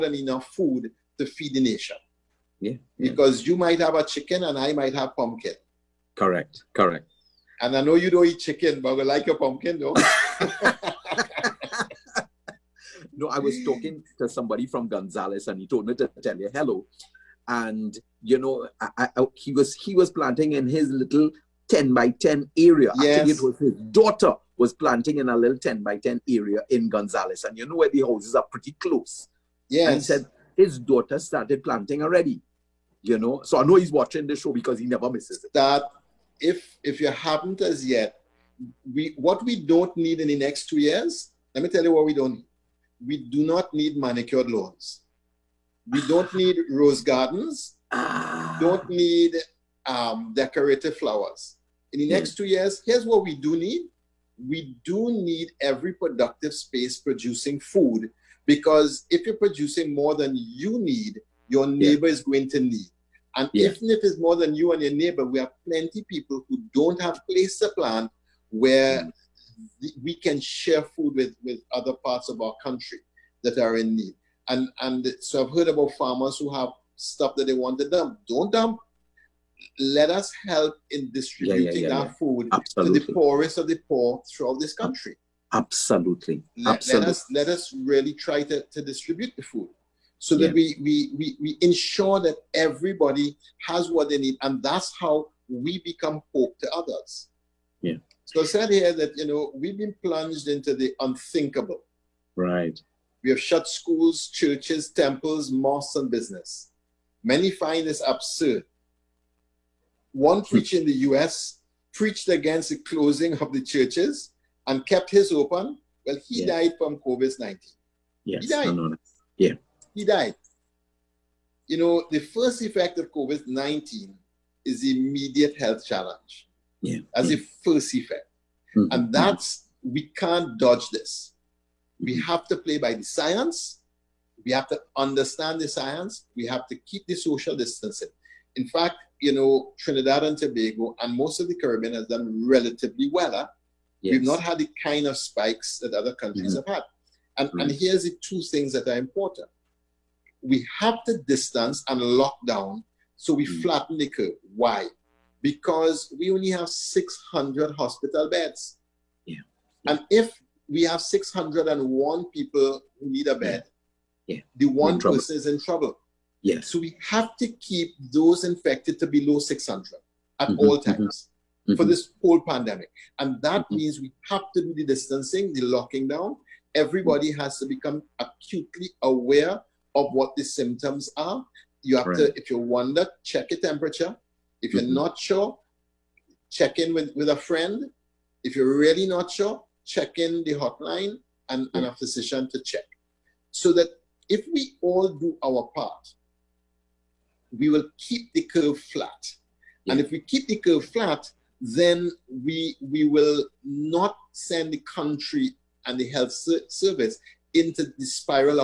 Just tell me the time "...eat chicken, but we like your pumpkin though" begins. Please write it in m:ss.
0:08.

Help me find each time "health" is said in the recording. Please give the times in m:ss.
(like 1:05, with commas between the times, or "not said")
2:05, 3:26.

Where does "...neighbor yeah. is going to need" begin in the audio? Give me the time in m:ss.
1:01.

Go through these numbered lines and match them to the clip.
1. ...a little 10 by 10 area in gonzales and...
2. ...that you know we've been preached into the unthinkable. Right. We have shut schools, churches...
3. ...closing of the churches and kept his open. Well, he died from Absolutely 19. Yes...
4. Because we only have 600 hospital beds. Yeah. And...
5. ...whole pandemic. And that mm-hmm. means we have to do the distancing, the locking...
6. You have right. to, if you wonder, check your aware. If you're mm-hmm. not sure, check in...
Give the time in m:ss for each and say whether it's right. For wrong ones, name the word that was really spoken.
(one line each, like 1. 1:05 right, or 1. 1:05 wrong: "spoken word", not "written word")
1. 0:25 right
2. 1:38 wrong: "plunged", not "preached"
3. 1:52 wrong: "COVID", not "Absolutely"
4. 2:35 right
5. 2:52 right
6. 3:01 wrong: "temperature", not "aware".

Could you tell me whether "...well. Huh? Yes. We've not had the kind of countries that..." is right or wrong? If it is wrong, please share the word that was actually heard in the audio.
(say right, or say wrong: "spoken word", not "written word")
wrong: "spikes", not "countries".